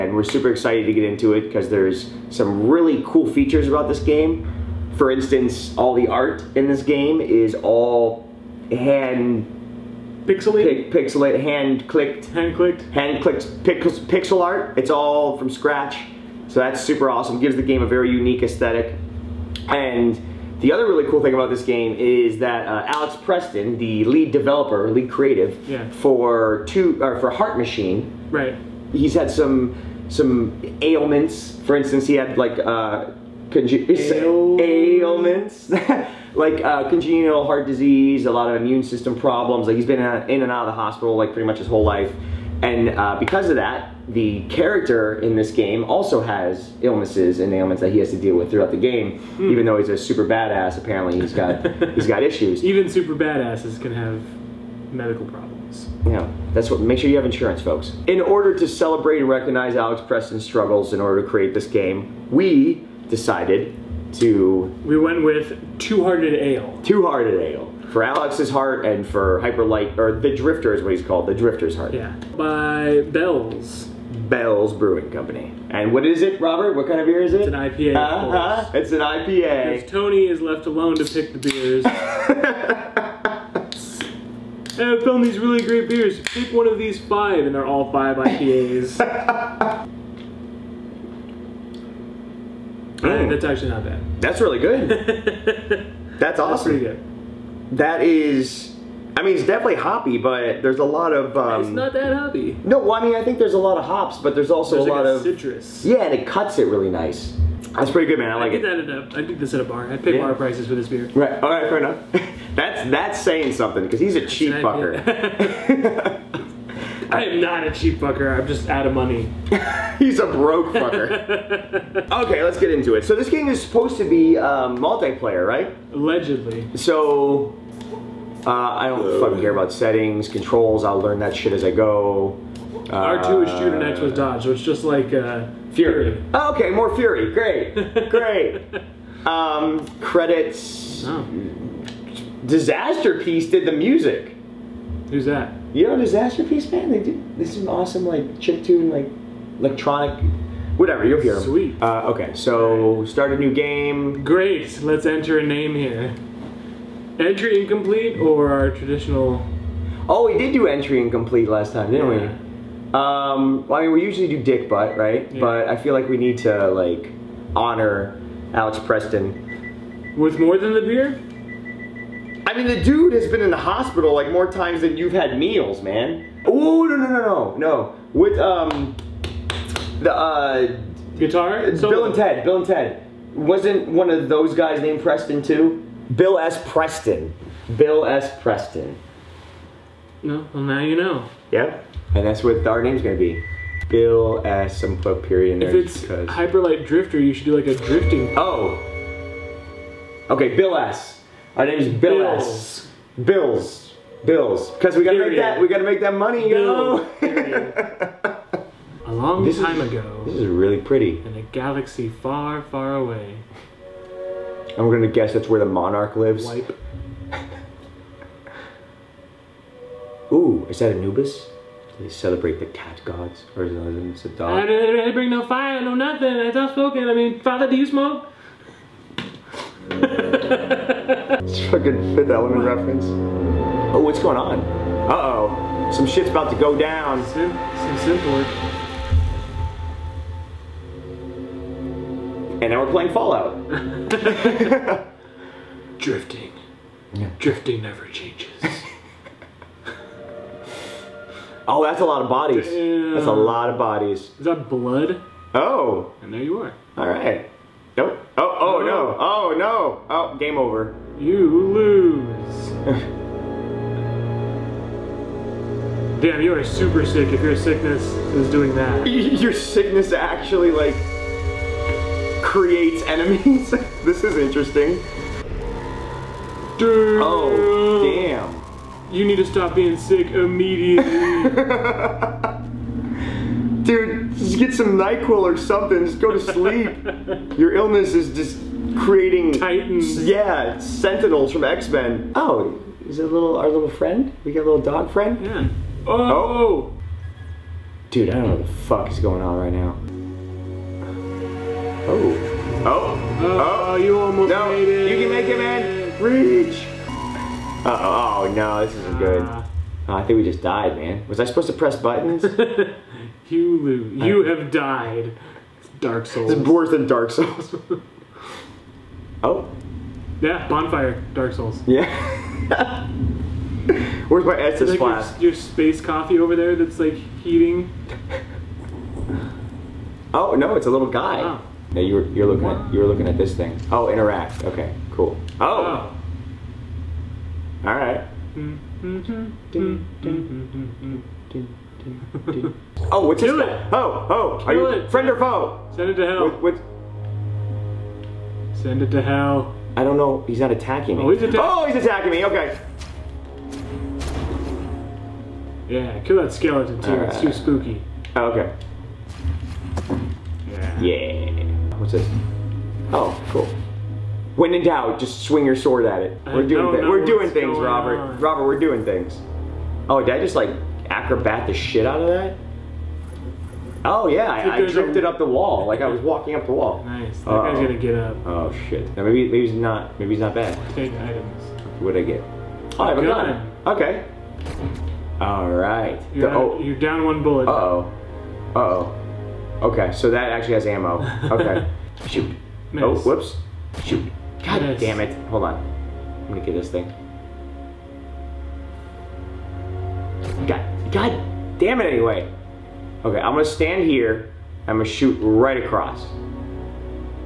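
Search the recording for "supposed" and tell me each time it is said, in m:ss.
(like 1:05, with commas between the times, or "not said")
2:03, 5:11.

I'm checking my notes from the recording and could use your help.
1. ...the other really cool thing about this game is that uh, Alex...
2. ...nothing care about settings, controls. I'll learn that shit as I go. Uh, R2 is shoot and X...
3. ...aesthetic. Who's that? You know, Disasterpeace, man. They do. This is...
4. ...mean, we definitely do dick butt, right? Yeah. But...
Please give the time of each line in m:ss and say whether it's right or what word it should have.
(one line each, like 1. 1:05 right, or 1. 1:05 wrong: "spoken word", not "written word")
1. 0:20 right
2. 2:09 wrong: "fucking", not "nothing"
3. 2:23 wrong: "music", not "aesthetic"
4. 2:43 wrong: "usually", not "definitely".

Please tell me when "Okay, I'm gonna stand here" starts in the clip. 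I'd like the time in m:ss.
6:43.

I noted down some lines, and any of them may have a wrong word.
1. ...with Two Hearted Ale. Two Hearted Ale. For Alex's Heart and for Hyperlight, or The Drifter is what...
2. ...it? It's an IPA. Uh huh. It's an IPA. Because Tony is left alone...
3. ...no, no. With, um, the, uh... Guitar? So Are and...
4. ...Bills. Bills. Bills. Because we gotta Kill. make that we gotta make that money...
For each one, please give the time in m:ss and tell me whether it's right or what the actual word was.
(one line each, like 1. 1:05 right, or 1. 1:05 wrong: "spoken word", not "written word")
1. 1:05 right
2. 1:17 right
3. 2:57 wrong: "Bill", not "Are"
4. 3:22 wrong: "Period", not "Kill".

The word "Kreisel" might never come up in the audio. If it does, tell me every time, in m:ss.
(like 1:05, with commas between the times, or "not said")
not said.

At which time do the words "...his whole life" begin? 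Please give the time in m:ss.
0:41.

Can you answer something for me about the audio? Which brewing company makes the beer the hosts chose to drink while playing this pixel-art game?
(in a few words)
Bell's Brewing Company.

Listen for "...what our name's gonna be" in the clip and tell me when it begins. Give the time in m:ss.
3:12.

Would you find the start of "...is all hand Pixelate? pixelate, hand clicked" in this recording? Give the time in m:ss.
0:07.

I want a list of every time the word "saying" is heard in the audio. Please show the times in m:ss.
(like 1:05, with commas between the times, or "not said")
1:53.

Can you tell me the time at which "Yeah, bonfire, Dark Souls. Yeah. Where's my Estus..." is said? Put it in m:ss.
5:20.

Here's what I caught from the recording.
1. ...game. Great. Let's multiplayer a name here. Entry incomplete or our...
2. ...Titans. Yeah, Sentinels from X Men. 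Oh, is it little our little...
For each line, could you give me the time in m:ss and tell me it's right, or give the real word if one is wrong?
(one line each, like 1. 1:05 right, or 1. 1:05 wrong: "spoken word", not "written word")
1. 2:33 wrong: "enter", not "multiplayer"
2. 4:49 right.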